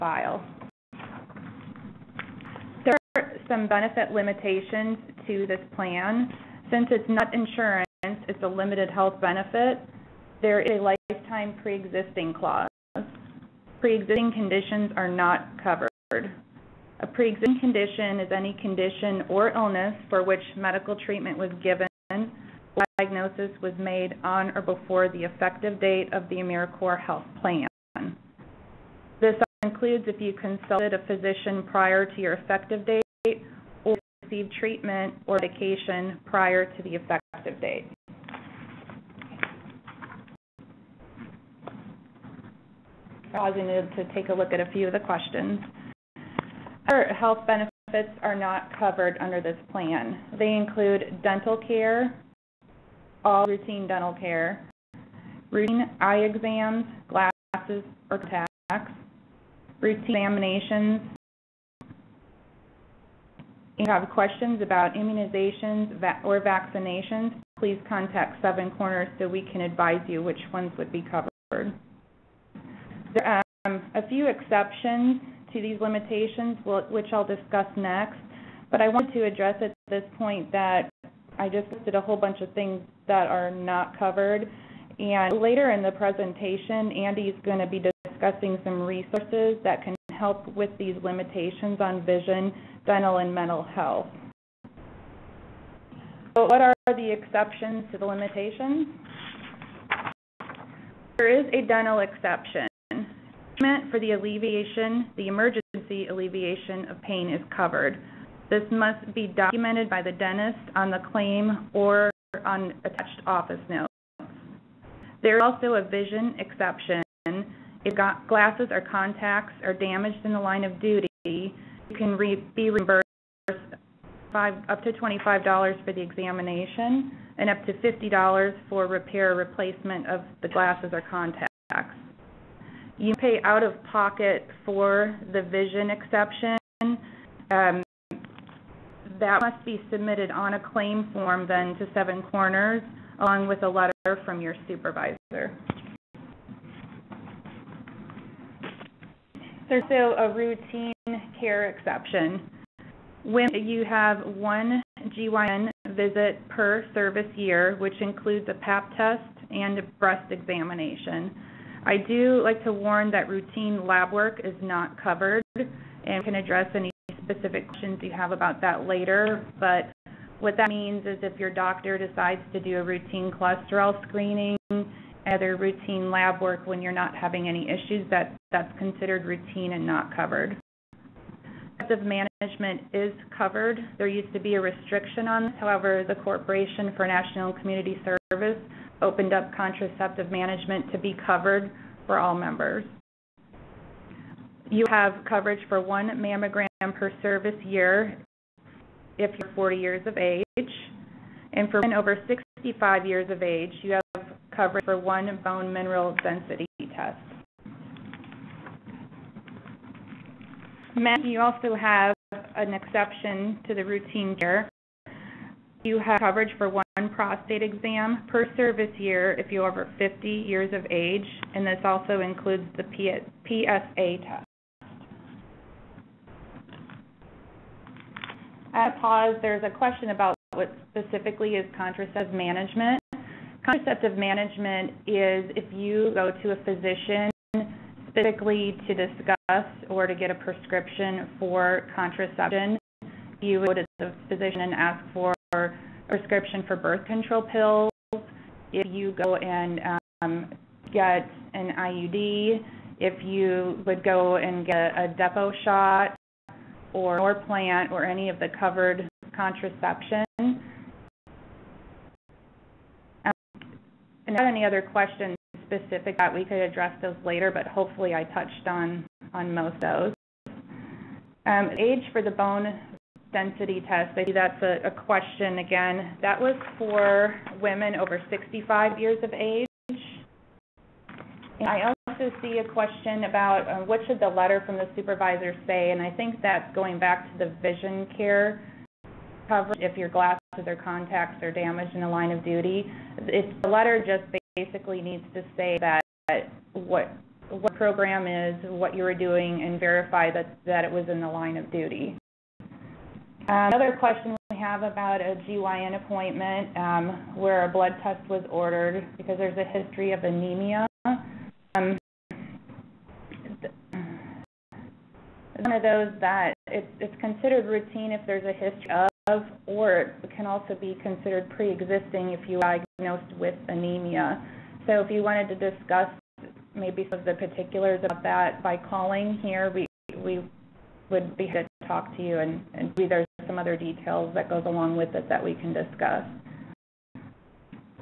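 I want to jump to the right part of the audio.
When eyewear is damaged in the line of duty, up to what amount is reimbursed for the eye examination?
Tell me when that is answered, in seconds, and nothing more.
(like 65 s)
124 s.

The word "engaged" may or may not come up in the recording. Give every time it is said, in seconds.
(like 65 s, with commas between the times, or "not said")
not said.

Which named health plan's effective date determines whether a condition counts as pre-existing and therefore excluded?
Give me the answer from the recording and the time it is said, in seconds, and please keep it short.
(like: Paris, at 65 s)
AmeriCorps Health Plan, at 26 s.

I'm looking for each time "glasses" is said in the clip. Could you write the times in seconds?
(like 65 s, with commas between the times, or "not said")
57 s, 118 s, 130 s, 290 s.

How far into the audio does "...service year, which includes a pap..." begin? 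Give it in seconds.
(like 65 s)
156 s.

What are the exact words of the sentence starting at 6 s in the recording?
Since it's not insurance, it's a limited health benefit.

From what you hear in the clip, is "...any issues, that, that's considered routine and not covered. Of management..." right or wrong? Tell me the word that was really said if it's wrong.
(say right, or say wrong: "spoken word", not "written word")
right.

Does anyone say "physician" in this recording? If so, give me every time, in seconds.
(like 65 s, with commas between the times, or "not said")
31 s, 236 s, 244 s.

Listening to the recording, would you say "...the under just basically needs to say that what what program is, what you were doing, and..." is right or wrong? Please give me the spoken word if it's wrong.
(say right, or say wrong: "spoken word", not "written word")
wrong: "letter", not "under".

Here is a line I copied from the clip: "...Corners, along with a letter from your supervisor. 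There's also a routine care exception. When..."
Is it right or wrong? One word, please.
right.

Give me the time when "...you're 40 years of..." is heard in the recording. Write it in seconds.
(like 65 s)
199 s.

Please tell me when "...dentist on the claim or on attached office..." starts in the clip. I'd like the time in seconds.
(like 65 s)
110 s.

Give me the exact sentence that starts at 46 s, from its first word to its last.
Our health benefits are not covered under this plan.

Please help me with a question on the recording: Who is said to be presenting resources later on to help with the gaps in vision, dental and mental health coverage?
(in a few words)
Andy.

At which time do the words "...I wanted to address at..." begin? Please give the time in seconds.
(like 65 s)
78 s.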